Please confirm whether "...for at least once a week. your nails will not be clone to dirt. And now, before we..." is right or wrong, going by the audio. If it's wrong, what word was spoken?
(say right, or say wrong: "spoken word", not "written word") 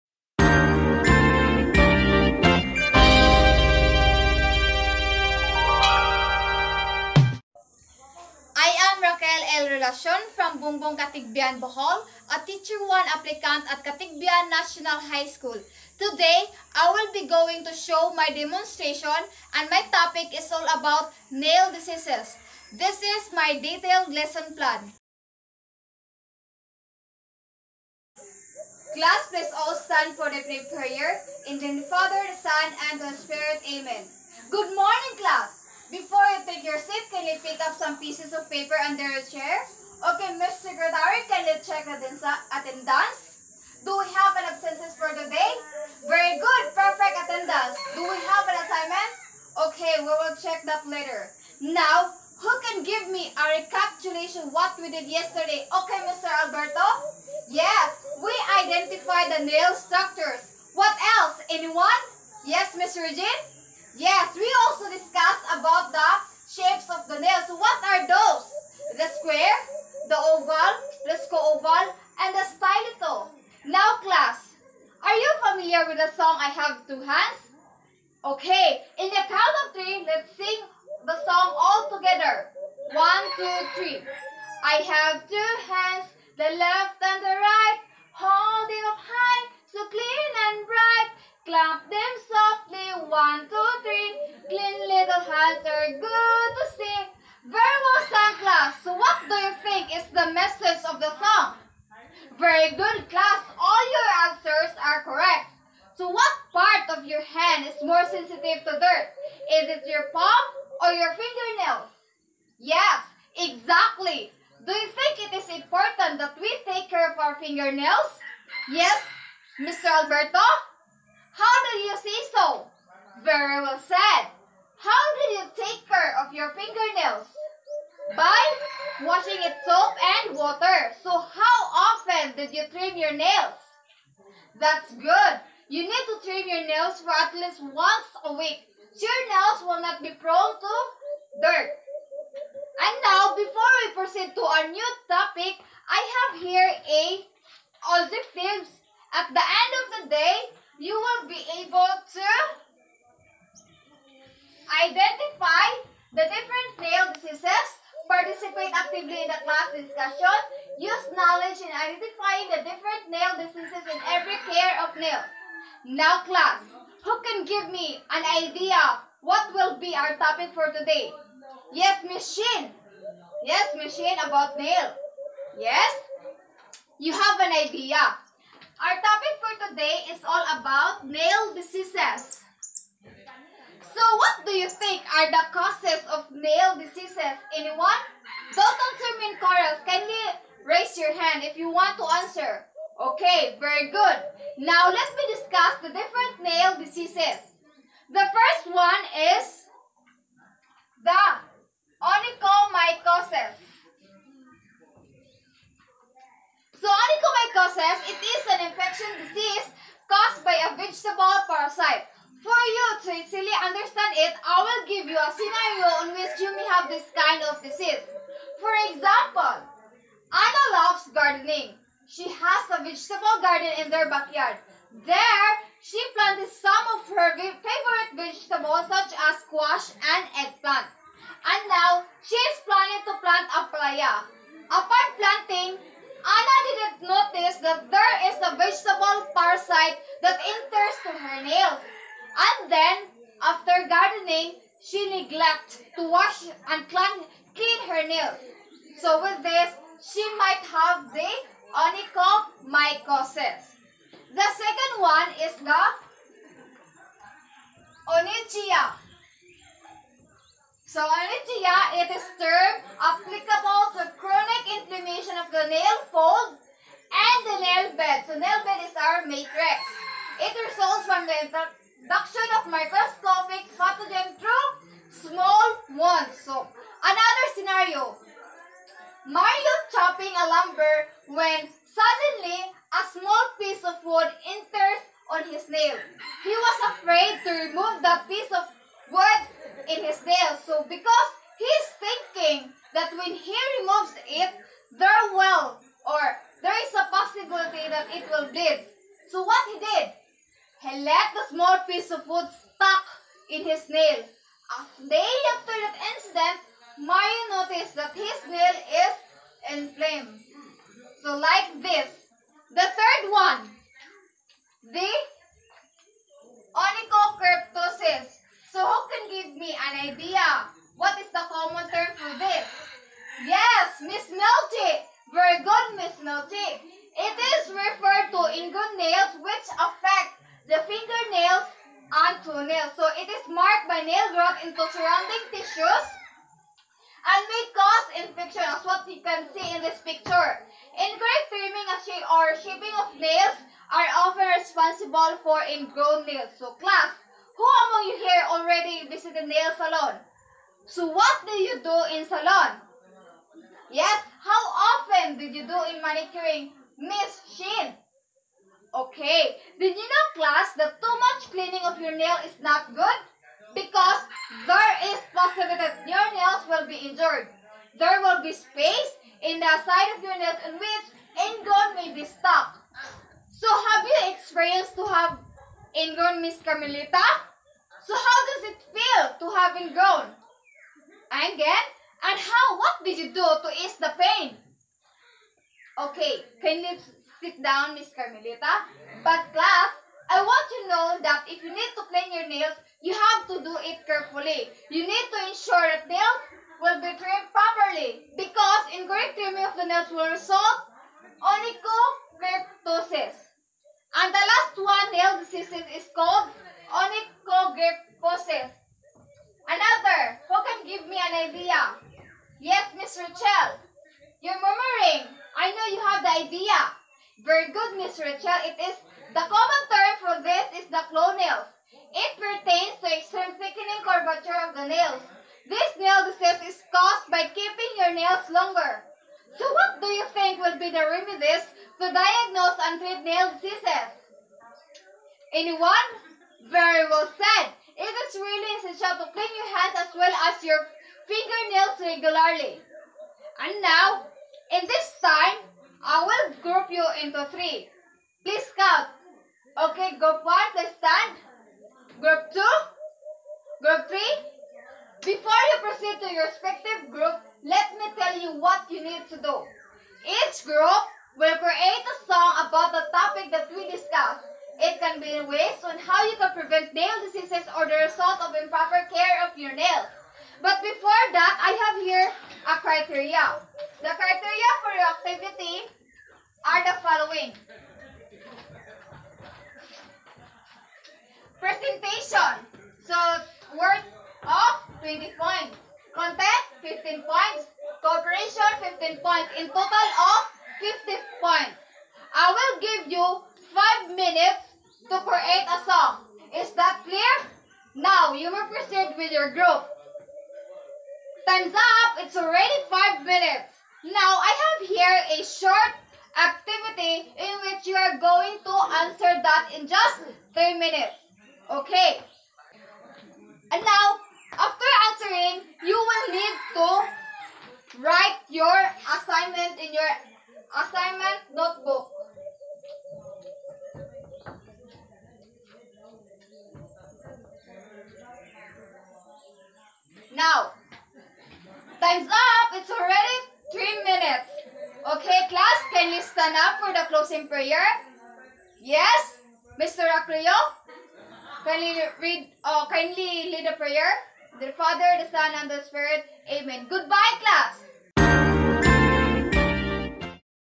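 wrong: "prone", not "clone".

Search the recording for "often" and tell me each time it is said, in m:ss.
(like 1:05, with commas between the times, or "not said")
2:11, 5:44, 5:54.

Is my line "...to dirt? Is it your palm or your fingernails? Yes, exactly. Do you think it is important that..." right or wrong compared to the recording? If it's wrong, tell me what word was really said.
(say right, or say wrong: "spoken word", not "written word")
right.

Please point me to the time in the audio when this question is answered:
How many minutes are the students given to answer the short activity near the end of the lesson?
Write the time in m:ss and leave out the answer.
8:30.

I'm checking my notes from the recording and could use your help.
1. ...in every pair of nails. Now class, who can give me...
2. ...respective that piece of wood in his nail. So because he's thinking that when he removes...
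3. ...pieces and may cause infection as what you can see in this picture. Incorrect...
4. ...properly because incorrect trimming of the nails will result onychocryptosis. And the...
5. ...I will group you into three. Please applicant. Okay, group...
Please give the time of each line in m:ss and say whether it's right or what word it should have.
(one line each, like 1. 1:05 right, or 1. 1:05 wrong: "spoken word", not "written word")
1. 2:43 right
2. 4:47 wrong: "remove", not "respective"
3. 5:35 wrong: "tissues", not "pieces"
4. 6:37 right
5. 7:26 wrong: "count", not "applicant".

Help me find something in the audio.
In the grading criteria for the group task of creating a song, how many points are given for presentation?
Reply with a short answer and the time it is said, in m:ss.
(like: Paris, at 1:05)
20, at 8:05.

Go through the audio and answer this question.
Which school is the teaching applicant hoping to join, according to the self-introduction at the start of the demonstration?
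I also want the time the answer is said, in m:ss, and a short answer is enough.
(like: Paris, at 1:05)
Katigbian National High School, at 0:13.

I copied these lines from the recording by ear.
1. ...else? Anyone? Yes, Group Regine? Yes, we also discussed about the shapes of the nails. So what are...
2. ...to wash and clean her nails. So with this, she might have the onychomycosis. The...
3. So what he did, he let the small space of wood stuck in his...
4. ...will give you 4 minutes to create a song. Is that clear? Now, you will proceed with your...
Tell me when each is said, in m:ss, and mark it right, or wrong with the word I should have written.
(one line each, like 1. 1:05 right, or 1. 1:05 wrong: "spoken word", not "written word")
1. 1:01 wrong: "Miss", not "Group"
2. 4:05 right
3. 4:59 wrong: "piece", not "space"
4. 8:12 wrong: "5", not "4".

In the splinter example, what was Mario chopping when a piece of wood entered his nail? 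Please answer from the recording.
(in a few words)
Lumber.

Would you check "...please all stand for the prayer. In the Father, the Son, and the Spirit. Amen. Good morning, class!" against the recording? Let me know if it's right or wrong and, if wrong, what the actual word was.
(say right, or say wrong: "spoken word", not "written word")
right.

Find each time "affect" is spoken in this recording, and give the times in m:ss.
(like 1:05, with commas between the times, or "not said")
5:29.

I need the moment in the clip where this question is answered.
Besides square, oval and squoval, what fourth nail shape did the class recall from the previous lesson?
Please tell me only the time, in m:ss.
1:12.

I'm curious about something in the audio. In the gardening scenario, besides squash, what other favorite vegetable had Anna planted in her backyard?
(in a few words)
Eggplant.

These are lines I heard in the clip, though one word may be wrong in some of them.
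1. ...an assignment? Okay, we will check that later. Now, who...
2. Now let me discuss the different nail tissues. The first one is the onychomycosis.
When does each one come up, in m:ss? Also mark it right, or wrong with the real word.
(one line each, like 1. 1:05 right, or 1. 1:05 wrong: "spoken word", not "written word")
1. 0:48 right
2. 3:14 wrong: "diseases", not "tissues".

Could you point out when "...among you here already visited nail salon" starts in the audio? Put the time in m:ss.
5:47.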